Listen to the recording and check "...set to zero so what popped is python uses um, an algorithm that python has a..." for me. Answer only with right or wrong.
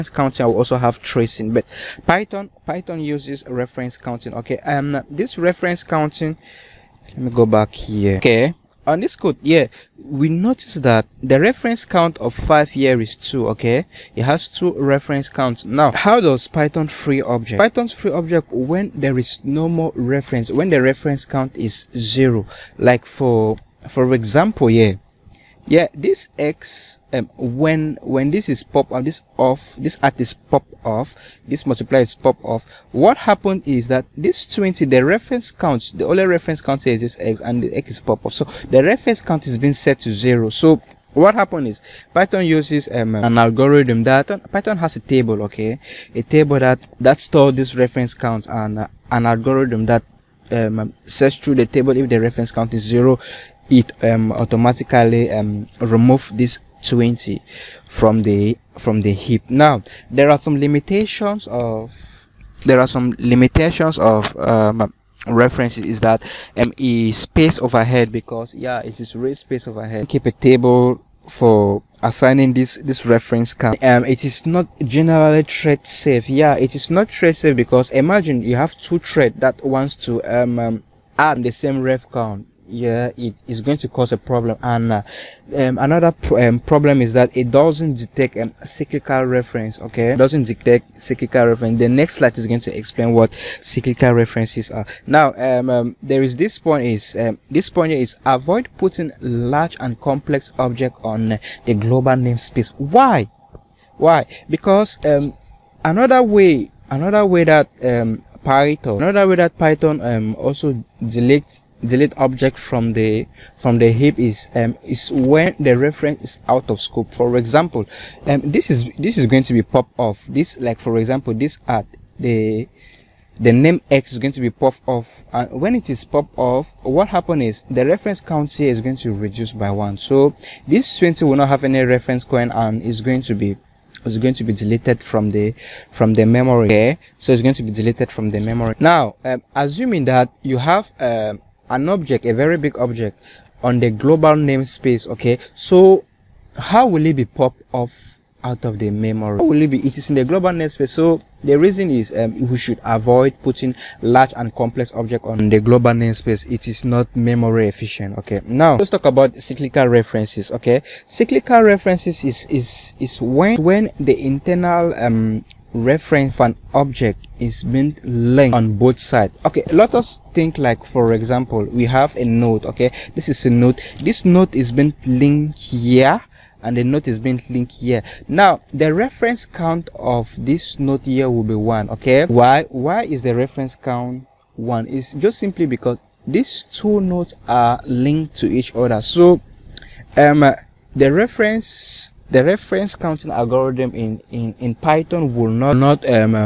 wrong.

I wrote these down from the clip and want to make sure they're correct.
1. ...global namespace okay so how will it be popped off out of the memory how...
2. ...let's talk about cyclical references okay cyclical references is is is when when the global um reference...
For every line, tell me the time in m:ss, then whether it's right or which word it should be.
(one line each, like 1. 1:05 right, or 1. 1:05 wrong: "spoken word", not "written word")
1. 2:23 right
2. 2:38 wrong: "internal", not "global".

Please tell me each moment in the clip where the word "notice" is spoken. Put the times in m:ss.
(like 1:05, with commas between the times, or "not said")
0:10.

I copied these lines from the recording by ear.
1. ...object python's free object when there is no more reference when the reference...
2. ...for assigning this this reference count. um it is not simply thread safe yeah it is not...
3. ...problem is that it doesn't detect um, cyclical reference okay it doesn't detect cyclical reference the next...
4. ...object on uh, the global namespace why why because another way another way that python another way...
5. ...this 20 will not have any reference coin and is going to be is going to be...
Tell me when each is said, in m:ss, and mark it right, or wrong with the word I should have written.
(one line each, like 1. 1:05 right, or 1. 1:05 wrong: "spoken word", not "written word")
1. 0:17 right
2. 1:11 wrong: "generally", not "simply"
3. 1:26 right
4. 1:40 right
5. 2:10 right.